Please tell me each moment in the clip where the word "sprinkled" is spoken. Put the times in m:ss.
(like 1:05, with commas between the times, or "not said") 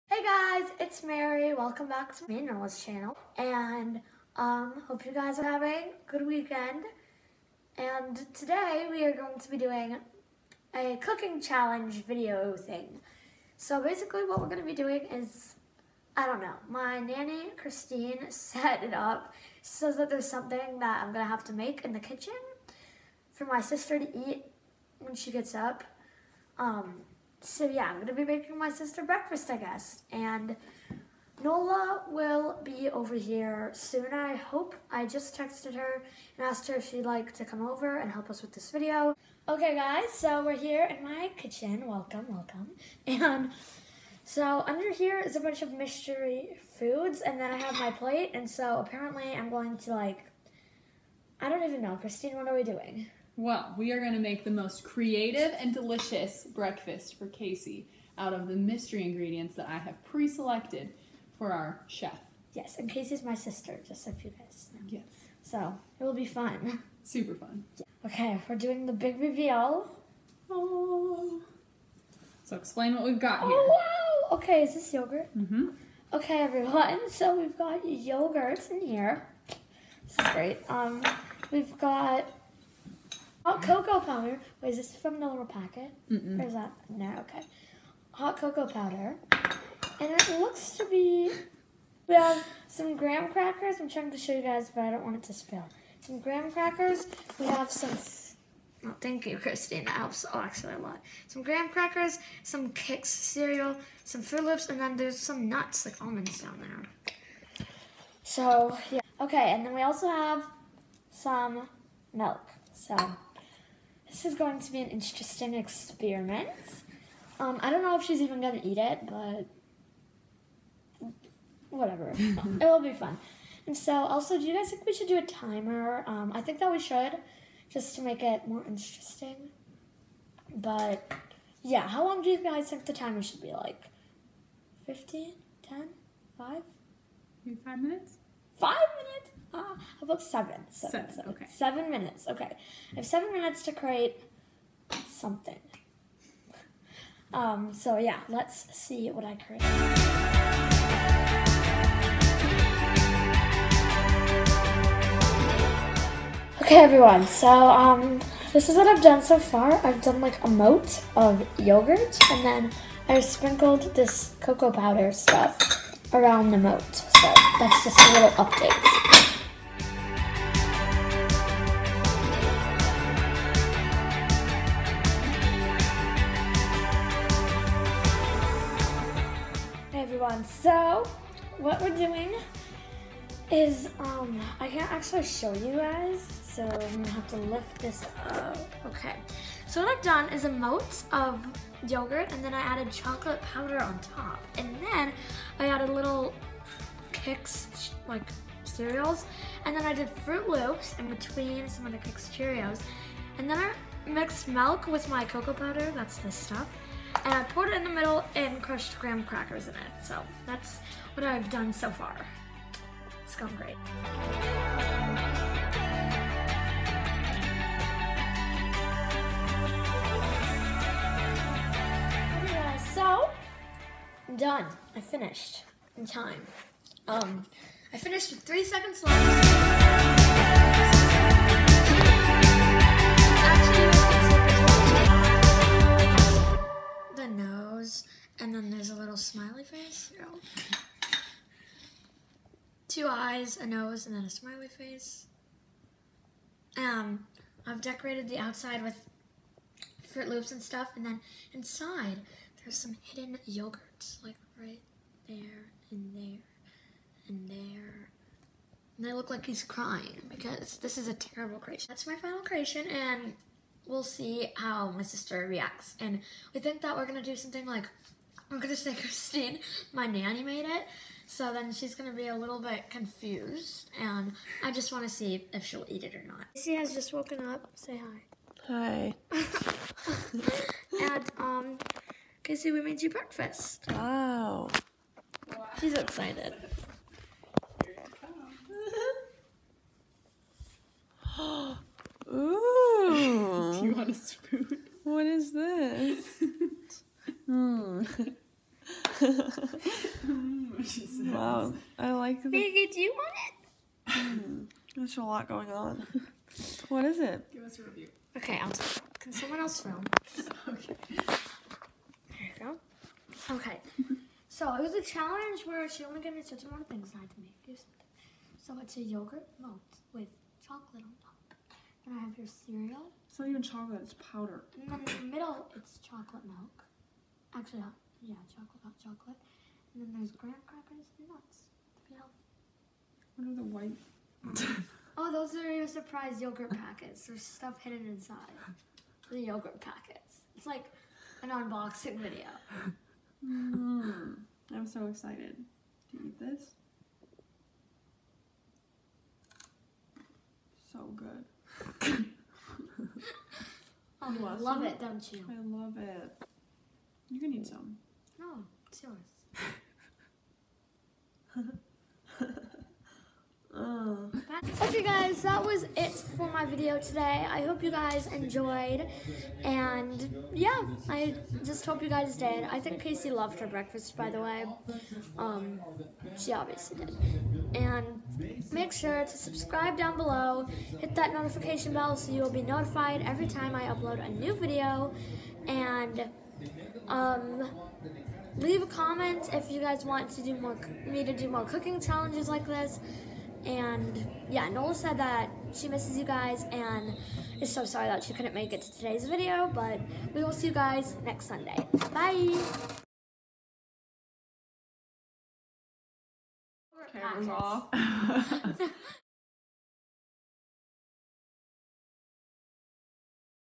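2:43.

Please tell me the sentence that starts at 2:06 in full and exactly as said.
Um, I think that we should, just to make it more interesting.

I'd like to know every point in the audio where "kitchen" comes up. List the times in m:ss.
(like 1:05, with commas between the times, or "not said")
0:21, 0:41.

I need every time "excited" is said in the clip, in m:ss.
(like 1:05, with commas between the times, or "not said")
4:45, 5:45.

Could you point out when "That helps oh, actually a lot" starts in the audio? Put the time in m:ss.
1:39.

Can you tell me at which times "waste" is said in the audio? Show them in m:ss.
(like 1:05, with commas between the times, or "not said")
not said.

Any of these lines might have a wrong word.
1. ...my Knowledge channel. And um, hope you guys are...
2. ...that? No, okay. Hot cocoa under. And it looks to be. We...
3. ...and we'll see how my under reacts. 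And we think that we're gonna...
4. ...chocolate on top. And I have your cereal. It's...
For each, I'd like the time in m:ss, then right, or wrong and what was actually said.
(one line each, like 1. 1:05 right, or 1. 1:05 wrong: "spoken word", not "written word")
1. 0:02 right
2. 1:26 wrong: "powder", not "under"
3. 4:22 wrong: "sister", not "under"
4. 5:20 right.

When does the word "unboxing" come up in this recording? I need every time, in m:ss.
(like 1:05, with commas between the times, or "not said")
5:41.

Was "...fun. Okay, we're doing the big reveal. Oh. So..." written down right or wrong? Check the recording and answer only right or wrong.
right.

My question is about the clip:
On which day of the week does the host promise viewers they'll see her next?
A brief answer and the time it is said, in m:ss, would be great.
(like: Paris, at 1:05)
Sunday, at 6:41.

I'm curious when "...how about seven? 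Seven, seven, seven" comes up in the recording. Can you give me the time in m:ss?
2:19.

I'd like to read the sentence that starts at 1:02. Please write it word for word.
Yes, and Casey's my sister, just a few days.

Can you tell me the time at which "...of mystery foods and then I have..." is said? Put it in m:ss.
0:45.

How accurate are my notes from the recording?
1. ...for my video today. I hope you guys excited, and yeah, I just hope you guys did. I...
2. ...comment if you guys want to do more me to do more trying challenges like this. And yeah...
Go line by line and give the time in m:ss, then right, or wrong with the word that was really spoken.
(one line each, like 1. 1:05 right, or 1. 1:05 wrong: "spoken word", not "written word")
1. 6:06 wrong: "enjoyed", not "excited"
2. 6:28 wrong: "cooking", not "trying".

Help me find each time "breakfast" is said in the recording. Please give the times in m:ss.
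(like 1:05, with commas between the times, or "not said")
0:29, 0:56, 4:43, 6:13.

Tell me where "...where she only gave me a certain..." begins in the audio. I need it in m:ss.
5:15.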